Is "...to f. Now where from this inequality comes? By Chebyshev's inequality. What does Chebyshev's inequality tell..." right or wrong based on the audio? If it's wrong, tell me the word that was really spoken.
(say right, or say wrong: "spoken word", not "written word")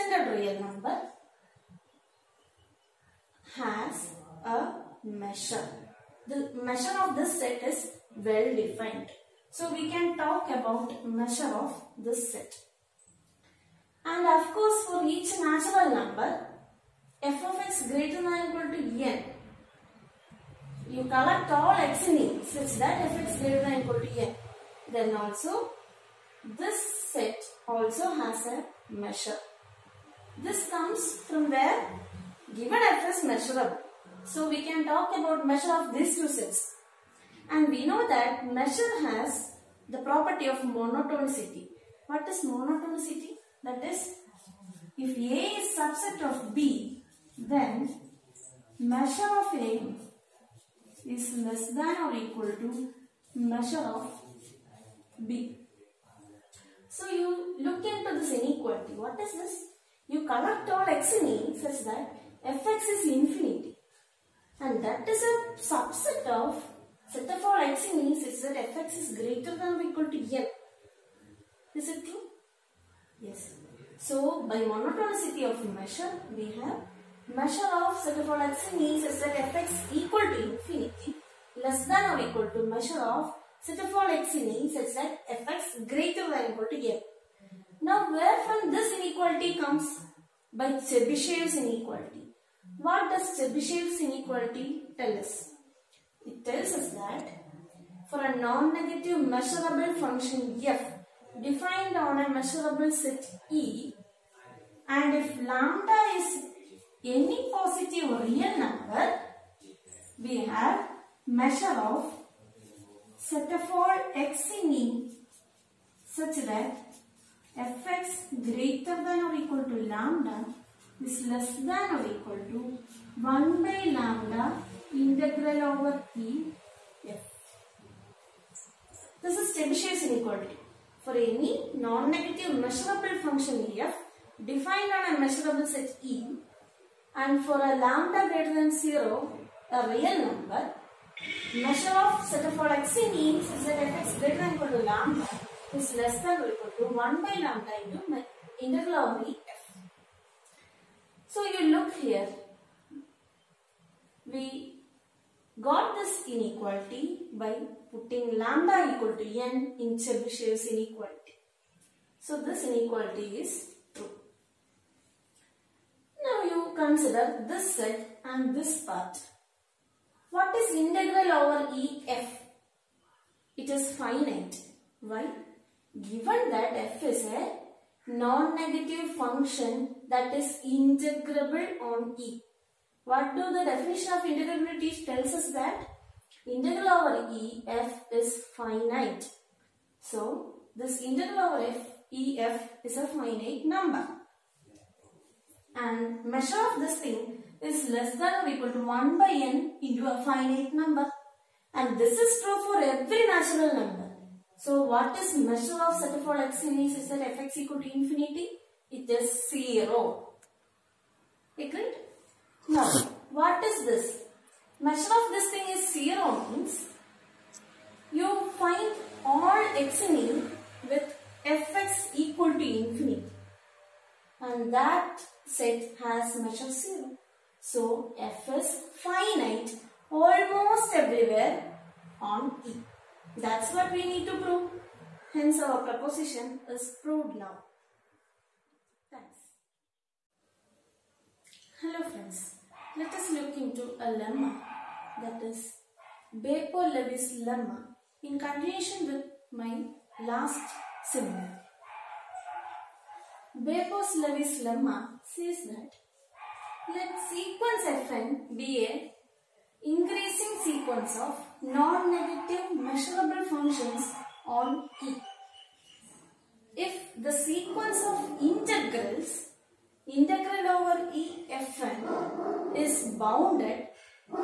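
right.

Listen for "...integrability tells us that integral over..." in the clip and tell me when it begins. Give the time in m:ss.
3:04.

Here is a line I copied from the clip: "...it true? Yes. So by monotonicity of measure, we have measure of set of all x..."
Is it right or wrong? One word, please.
right.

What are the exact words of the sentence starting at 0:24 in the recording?
Then also, this set also has a measure.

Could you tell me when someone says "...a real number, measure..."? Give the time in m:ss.
2:19.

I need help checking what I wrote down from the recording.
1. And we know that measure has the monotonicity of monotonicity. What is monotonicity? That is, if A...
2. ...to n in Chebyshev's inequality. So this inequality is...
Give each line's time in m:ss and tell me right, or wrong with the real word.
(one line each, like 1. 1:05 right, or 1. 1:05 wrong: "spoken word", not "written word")
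1. 0:37 wrong: "property", not "monotonicity"
2. 2:39 right.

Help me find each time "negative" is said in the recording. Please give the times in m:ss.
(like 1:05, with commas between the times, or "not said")
1:38, 2:11, 2:58, 4:21.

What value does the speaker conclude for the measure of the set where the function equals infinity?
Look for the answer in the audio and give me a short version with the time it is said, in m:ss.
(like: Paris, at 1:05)
0, at 3:28.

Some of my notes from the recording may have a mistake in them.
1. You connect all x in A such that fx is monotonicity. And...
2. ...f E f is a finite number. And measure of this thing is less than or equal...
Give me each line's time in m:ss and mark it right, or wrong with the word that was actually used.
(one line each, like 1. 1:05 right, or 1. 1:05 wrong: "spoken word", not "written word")
1. 1:00 wrong: "infinity", not "monotonicity"
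2. 3:11 right.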